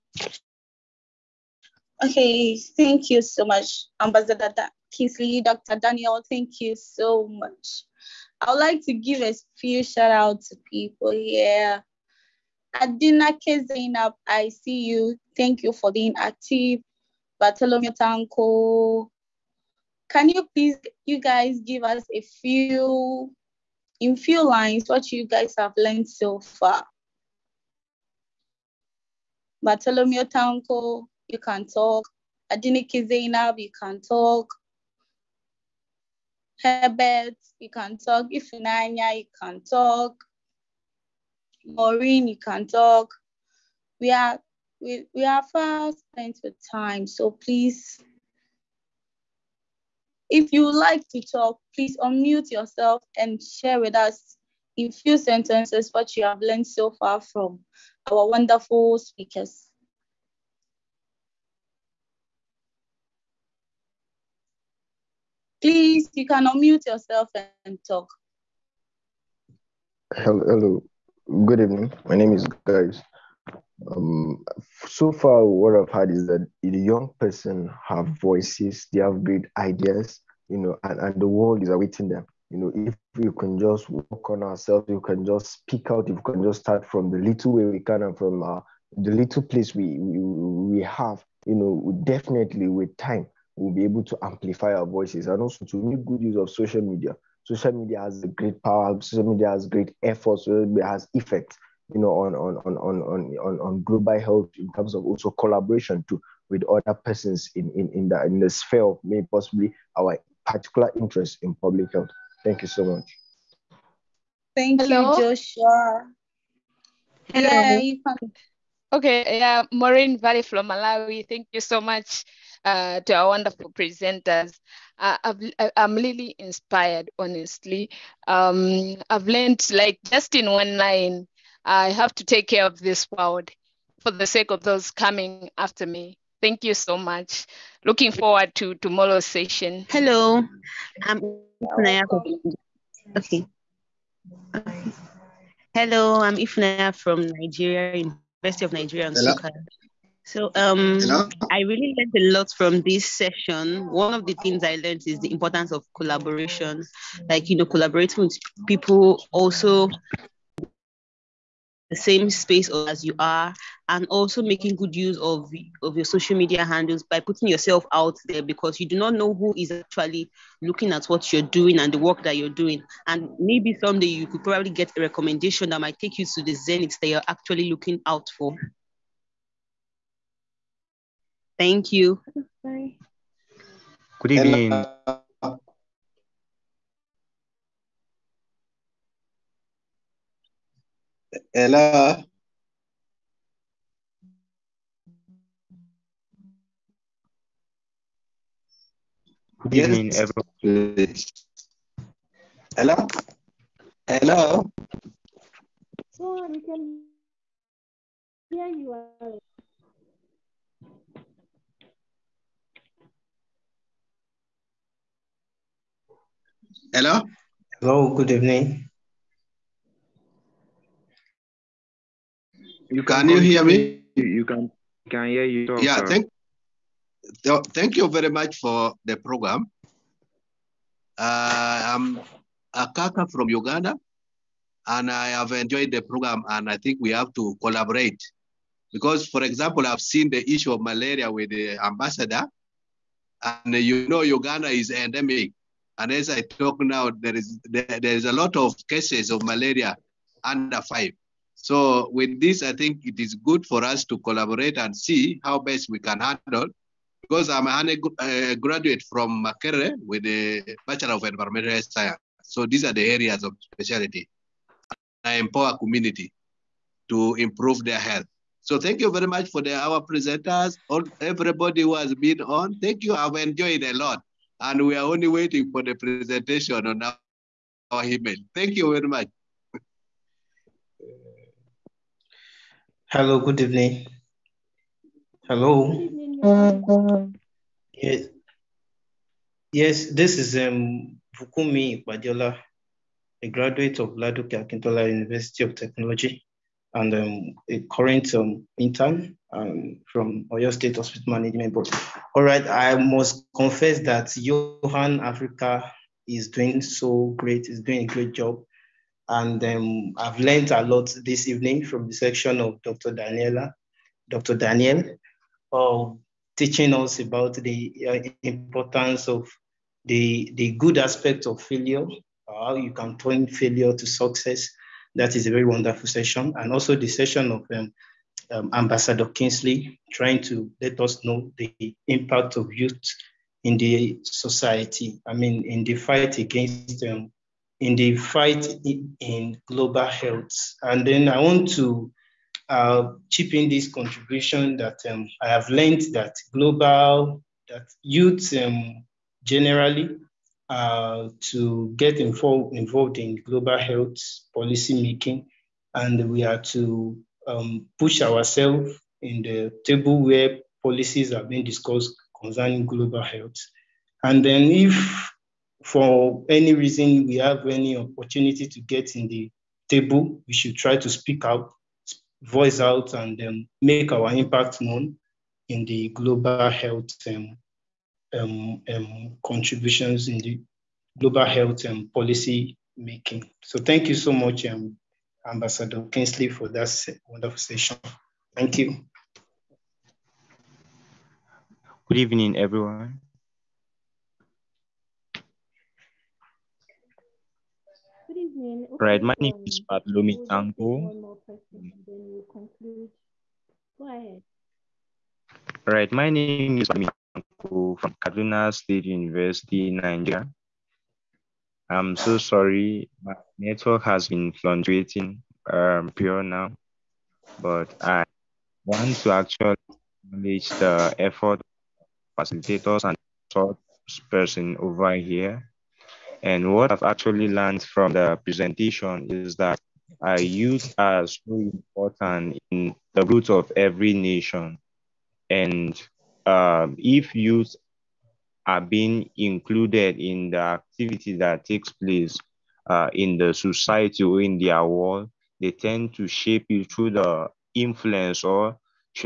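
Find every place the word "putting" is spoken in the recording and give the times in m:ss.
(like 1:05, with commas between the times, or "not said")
2:47.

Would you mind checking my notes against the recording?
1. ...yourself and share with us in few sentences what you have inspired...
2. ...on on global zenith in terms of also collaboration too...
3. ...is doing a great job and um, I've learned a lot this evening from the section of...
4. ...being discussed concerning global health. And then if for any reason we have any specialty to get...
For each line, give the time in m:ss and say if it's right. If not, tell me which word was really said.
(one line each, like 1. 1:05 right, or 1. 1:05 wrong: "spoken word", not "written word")
1. 0:52 wrong: "learned", not "inspired"
2. 1:43 wrong: "health", not "zenith"
3. 5:07 right
4. 6:01 wrong: "opportunity", not "specialty".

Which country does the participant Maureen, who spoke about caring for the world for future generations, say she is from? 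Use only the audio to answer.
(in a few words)
Malawi.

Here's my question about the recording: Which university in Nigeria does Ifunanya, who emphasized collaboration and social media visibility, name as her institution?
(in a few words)
University of Nigeria.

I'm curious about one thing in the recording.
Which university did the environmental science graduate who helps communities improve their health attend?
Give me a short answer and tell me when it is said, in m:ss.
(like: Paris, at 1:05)
Makerere, at 4:19.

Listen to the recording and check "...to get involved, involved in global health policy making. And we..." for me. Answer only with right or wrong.
right.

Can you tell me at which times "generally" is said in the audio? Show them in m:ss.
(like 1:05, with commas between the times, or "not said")
5:49.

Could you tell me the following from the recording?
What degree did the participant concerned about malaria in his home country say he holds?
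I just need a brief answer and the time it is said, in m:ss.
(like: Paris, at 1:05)
Bachelor of Environmental Science, at 4:20.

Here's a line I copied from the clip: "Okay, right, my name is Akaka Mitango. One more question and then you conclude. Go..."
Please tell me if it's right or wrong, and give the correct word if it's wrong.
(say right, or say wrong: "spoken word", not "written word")
wrong: "Pat", not "Akaka".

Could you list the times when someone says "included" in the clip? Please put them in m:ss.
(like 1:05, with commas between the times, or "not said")
7:19.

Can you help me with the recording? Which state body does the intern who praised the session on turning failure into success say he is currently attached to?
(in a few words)
Oyo State Hospital Management Board.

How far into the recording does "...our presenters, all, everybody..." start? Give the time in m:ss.
4:29.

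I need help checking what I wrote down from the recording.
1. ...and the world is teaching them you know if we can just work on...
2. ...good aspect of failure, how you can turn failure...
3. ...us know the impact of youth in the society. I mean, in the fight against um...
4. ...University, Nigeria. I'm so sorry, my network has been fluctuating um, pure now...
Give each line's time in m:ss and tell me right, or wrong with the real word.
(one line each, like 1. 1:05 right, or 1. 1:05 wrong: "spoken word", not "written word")
1. 1:20 wrong: "awaiting", not "teaching"
2. 5:20 right
3. 5:30 right
4. 6:49 right.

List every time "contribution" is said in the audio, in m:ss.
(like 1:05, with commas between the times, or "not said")
5:43, 6:19.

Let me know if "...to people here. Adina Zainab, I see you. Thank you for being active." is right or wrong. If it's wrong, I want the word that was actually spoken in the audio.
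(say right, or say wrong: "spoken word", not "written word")
right.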